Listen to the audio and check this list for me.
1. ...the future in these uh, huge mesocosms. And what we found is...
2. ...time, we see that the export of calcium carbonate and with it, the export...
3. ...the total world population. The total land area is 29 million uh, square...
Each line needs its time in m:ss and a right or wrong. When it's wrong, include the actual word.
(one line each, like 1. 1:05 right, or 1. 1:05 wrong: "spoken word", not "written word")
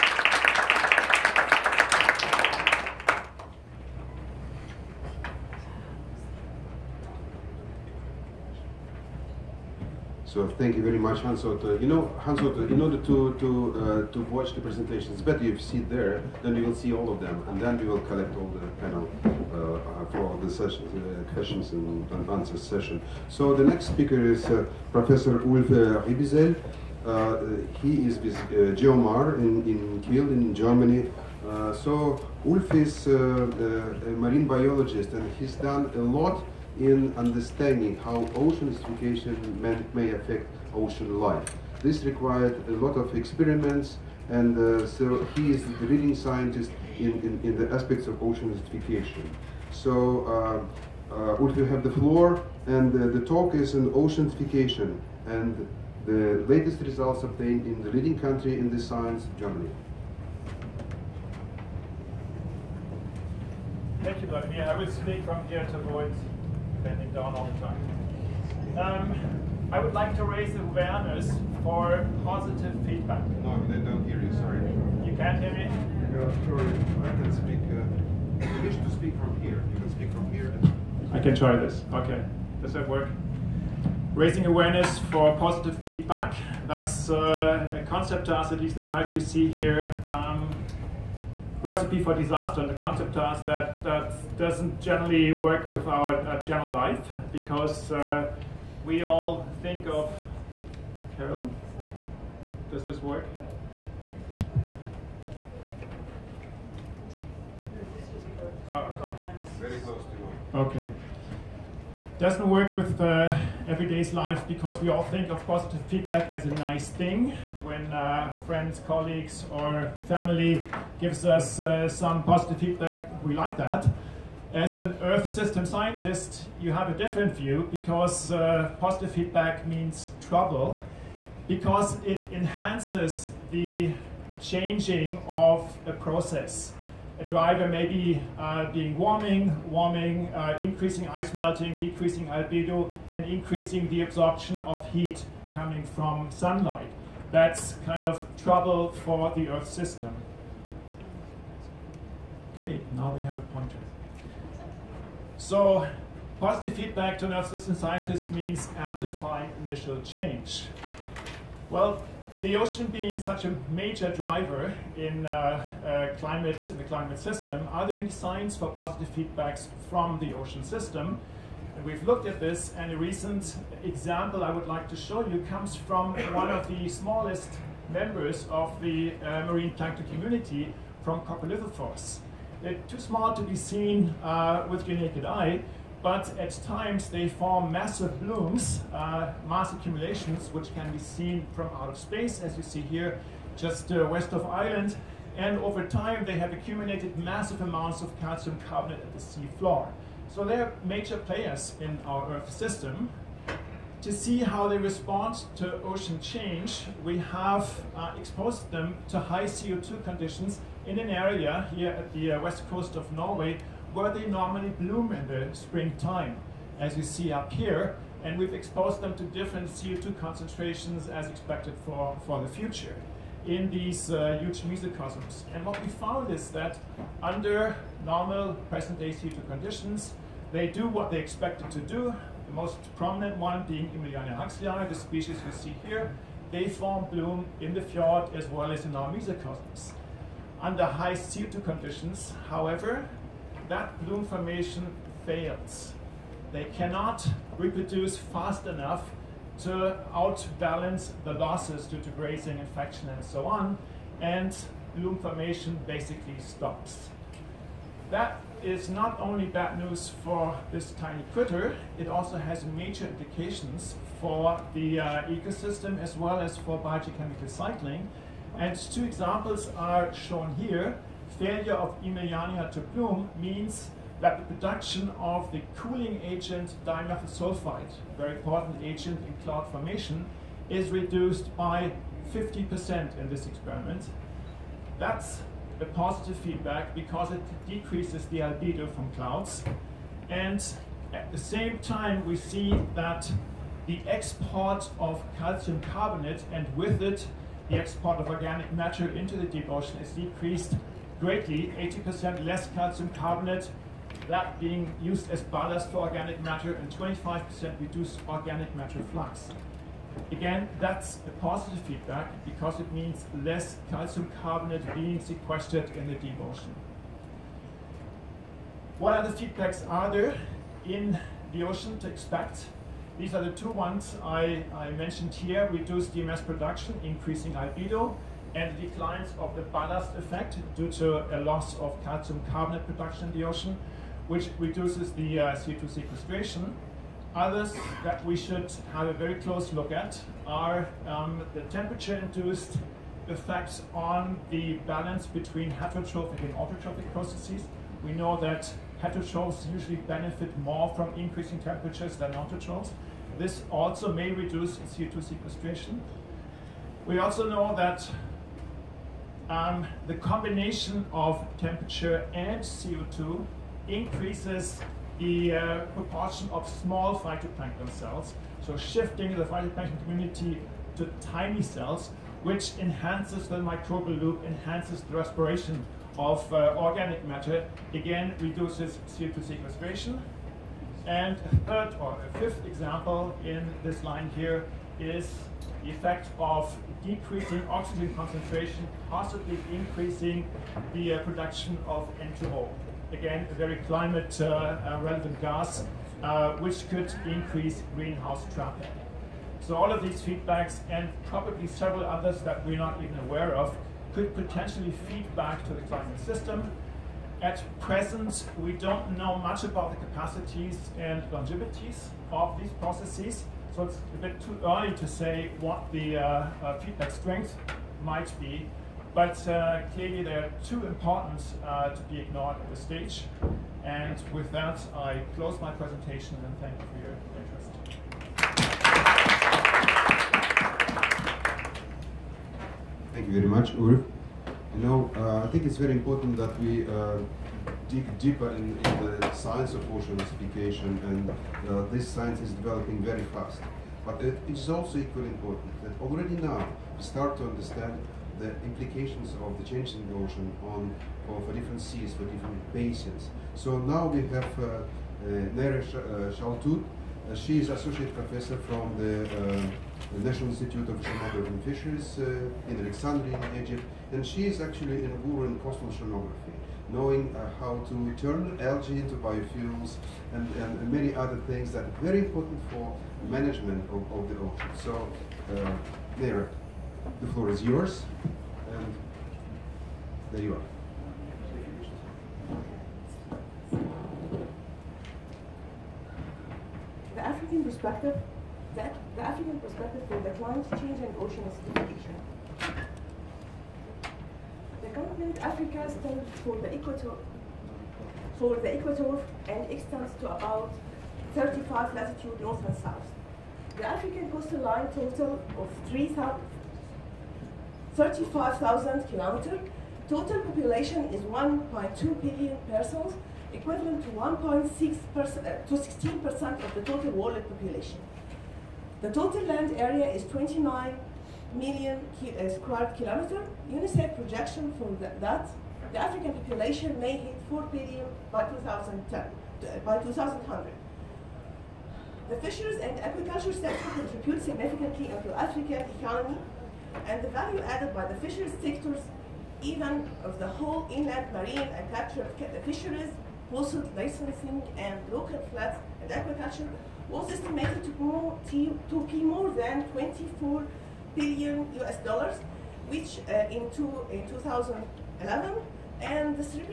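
1. 3:42 right
2. 4:51 right
3. 8:36 right.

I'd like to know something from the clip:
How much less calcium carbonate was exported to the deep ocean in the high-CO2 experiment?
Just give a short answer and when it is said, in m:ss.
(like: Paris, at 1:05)
80%, at 5:01.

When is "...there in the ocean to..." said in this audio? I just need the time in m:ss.
5:20.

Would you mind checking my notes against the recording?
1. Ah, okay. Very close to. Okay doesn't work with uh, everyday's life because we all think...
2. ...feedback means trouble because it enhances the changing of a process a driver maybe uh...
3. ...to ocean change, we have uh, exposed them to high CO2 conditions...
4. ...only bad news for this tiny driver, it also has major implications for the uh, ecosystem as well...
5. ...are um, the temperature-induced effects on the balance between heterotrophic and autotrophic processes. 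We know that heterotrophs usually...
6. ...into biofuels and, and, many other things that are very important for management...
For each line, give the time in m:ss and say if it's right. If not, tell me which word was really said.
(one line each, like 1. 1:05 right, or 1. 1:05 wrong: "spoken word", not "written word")
1. 1:48 right
2. 2:09 right
3. 3:25 right
4. 4:19 wrong: "critter", not "driver"
5. 5:40 right
6. 7:48 right.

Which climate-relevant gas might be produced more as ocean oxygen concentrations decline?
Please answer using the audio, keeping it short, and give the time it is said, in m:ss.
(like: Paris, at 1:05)
N2O, at 6:32.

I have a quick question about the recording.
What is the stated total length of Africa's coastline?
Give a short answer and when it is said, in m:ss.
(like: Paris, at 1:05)
35,000 kilometers, at 8:25.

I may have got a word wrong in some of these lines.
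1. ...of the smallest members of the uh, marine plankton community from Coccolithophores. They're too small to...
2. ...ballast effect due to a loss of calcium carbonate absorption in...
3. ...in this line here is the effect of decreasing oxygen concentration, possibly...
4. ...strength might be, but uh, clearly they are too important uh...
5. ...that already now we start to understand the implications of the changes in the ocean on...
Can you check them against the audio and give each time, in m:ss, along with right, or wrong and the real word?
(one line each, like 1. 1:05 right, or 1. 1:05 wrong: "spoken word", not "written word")
1. 2:56 right
2. 5:29 wrong: "production", not "absorption"
3. 6:23 right
4. 6:57 right
5. 7:25 right.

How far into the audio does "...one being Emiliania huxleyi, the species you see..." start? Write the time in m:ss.
3:53.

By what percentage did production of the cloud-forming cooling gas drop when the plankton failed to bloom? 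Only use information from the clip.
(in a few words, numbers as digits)
50%.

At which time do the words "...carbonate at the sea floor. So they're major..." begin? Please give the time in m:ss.
3:18.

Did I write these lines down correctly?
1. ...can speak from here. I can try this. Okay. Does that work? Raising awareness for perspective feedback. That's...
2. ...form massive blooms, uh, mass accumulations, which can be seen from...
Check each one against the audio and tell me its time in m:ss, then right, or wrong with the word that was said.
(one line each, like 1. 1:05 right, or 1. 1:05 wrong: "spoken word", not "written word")
1. 1:19 wrong: "positive", not "perspective"
2. 3:07 right.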